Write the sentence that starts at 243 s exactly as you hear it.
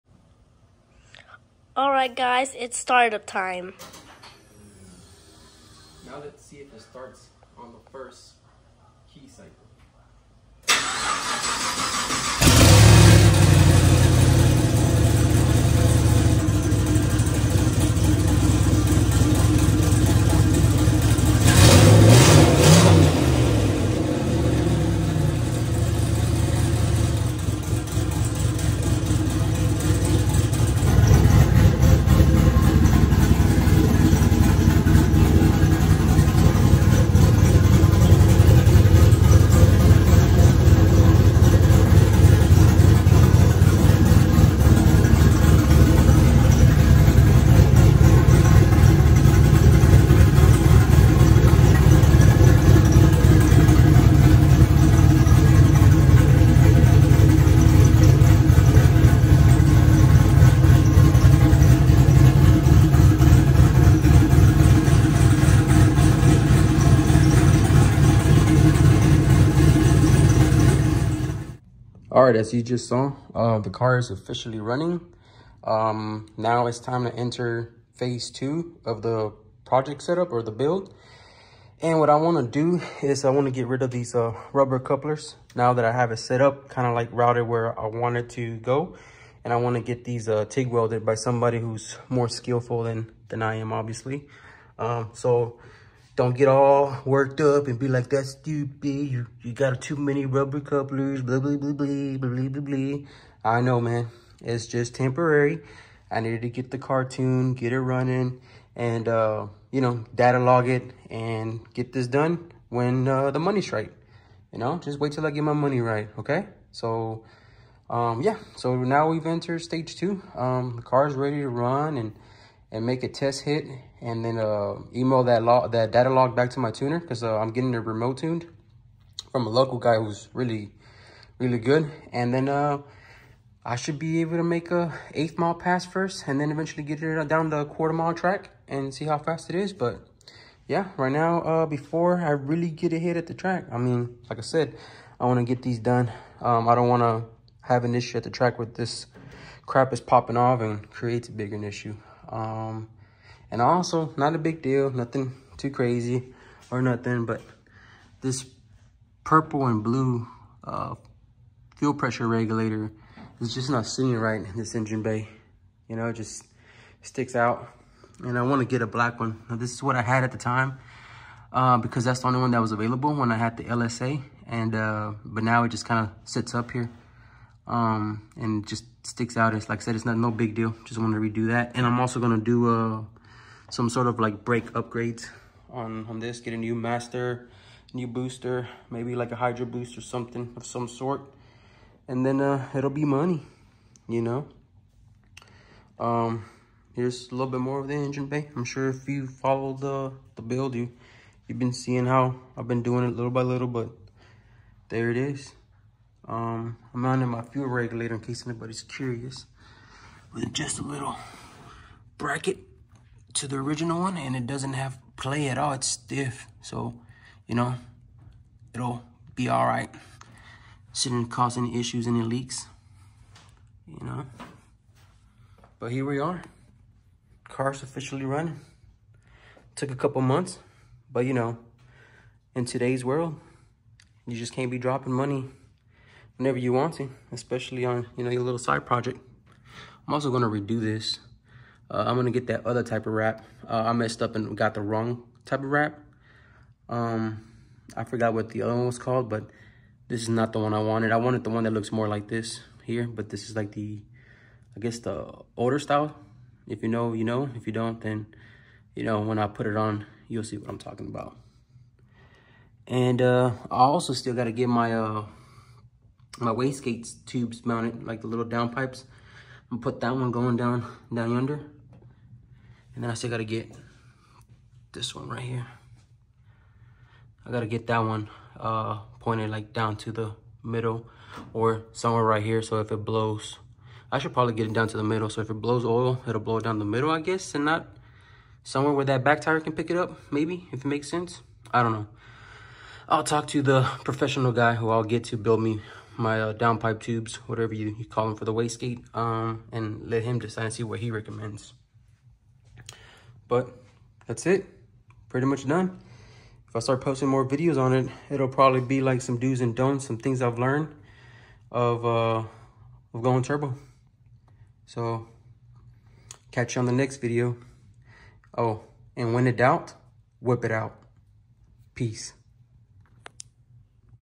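Uh, I messed up and got the wrong type of wrap.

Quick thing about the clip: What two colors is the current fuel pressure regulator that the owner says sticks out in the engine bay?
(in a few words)
purple and blue.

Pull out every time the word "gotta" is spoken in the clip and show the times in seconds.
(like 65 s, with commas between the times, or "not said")
273 s, 277 s.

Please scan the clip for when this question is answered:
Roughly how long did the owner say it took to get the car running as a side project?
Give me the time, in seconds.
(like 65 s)
229 s.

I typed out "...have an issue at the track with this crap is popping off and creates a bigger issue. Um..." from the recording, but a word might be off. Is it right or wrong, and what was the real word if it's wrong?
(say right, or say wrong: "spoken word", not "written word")
right.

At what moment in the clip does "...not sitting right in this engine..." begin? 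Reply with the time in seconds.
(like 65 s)
163 s.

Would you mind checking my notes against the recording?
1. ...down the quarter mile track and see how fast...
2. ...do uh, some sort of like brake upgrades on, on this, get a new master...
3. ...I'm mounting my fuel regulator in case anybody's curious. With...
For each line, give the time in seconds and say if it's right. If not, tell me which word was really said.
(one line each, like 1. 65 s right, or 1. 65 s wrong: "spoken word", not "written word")
1. 137 s right
2. 182 s right
3. 206 s right.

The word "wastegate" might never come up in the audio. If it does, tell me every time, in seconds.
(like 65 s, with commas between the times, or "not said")
266 s, 298 s.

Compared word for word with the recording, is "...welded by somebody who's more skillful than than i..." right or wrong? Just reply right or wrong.
right.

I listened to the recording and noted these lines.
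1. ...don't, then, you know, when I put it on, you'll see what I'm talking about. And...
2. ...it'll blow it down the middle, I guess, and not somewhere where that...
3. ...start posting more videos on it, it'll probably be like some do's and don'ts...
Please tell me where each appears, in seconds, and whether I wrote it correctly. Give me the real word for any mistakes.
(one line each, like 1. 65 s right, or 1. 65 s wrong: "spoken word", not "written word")
1. 257 s right
2. 286 s right
3. 306 s right.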